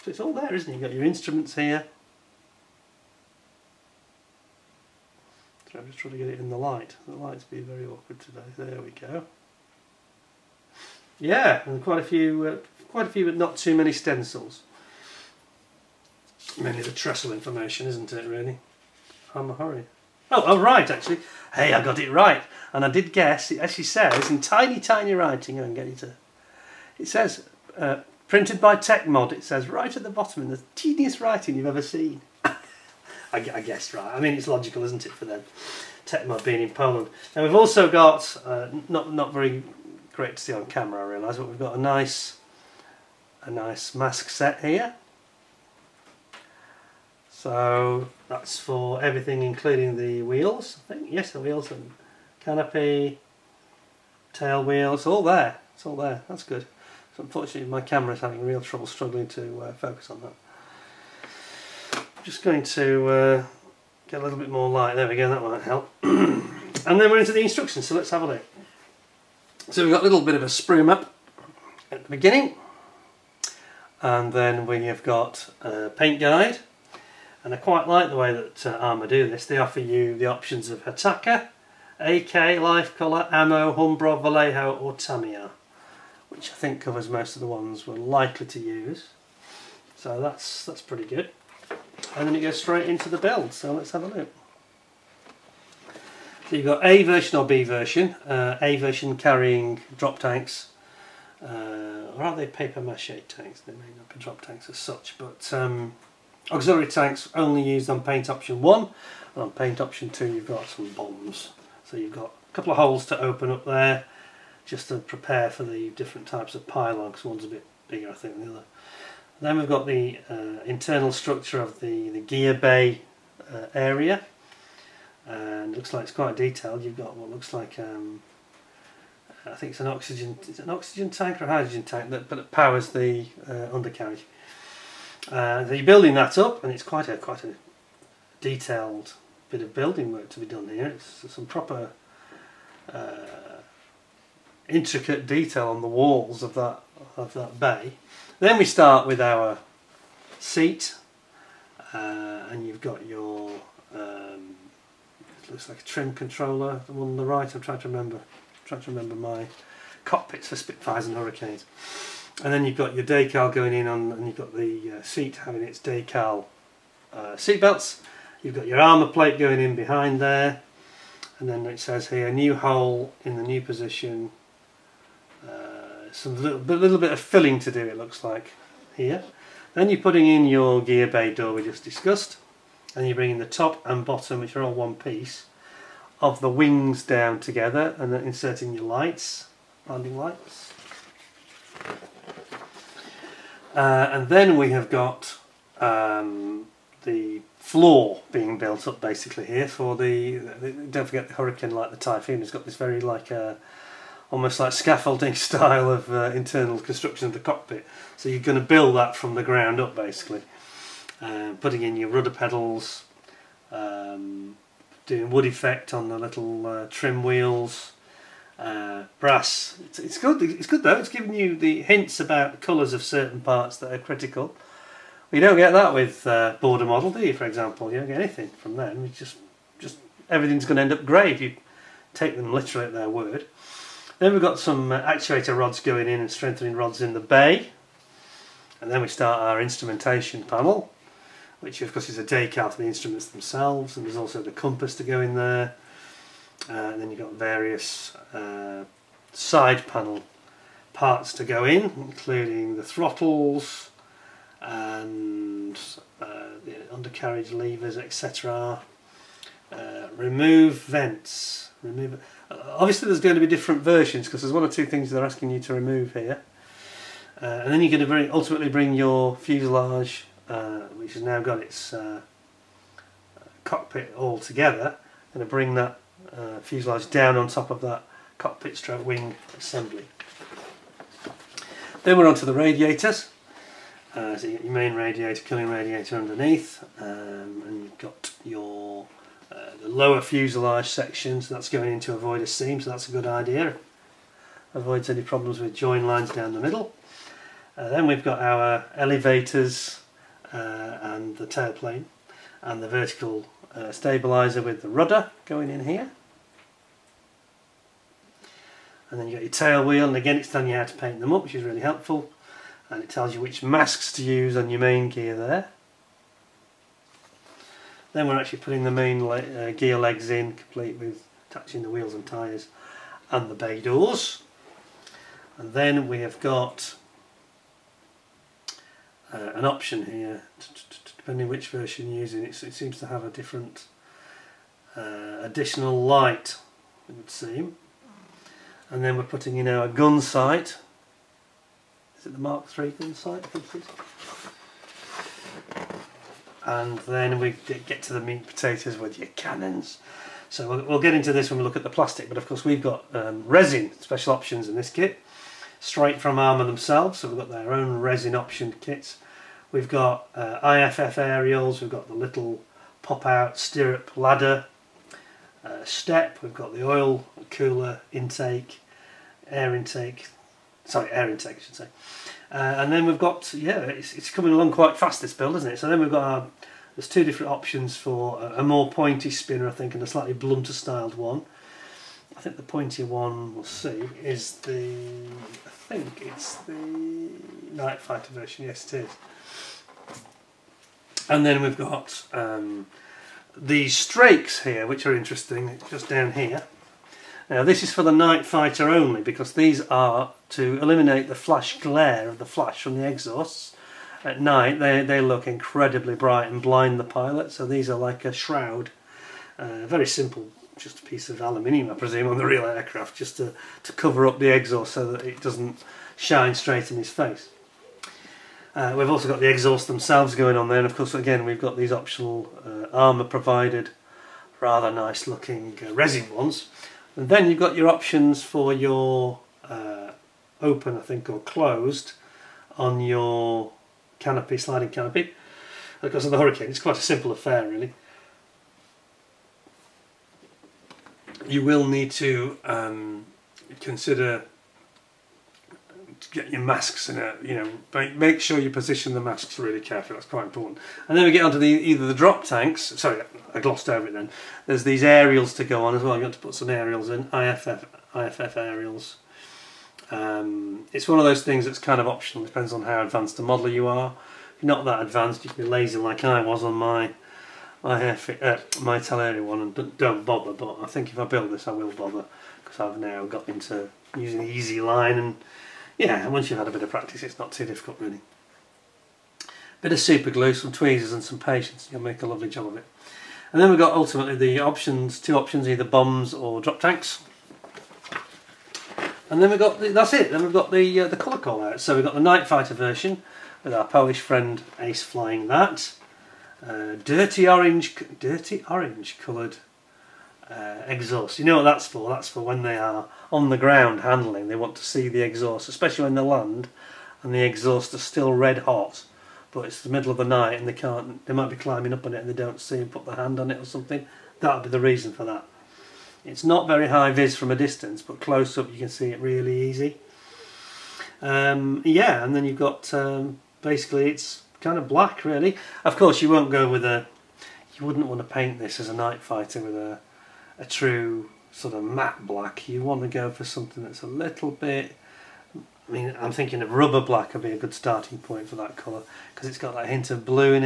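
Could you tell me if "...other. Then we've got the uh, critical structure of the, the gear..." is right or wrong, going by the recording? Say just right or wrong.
wrong.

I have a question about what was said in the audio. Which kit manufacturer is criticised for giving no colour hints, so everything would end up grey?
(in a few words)
Border Model.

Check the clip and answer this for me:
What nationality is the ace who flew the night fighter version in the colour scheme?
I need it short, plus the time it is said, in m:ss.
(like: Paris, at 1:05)
Polish, at 8:13.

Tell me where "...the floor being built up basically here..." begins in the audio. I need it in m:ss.
3:17.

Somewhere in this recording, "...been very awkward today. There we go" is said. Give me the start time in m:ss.
0:07.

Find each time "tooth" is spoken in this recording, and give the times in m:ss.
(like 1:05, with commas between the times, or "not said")
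not said.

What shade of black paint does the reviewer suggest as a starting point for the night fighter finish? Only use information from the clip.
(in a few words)
Rubber black.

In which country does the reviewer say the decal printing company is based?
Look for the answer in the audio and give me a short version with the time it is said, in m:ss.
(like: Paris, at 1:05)
Poland, at 0:36.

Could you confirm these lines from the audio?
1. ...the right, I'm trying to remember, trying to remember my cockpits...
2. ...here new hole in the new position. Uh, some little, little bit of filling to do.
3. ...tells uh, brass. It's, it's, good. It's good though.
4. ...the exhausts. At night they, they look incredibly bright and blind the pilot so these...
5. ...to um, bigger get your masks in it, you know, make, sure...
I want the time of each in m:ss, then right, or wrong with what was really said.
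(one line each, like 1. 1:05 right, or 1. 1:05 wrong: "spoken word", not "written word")
1. 2:37 right
2. 2:52 right
3. 3:37 wrong: "wheels", not "tells"
4. 6:42 right
5. 7:22 wrong: "consider", not "bigger".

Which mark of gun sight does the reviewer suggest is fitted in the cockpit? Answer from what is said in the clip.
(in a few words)
Mark III.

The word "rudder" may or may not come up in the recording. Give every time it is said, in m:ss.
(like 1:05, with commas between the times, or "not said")
3:32, 5:04.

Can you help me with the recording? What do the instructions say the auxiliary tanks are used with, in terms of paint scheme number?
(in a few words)
Paint option 1.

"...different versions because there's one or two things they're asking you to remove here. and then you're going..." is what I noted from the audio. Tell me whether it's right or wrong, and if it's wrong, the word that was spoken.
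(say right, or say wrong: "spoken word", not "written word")
right.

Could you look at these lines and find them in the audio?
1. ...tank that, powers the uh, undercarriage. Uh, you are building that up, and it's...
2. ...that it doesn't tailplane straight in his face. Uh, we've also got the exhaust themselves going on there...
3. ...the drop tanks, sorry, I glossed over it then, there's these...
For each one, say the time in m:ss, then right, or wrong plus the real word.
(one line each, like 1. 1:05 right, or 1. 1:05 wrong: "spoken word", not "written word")
1. 2:11 right
2. 6:55 wrong: "shine", not "tailplane"
3. 7:32 right.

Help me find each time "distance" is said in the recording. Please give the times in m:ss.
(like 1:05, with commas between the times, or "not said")
8:37.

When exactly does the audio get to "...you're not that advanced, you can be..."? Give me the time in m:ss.
7:44.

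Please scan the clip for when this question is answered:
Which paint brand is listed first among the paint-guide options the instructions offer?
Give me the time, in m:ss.
1:20.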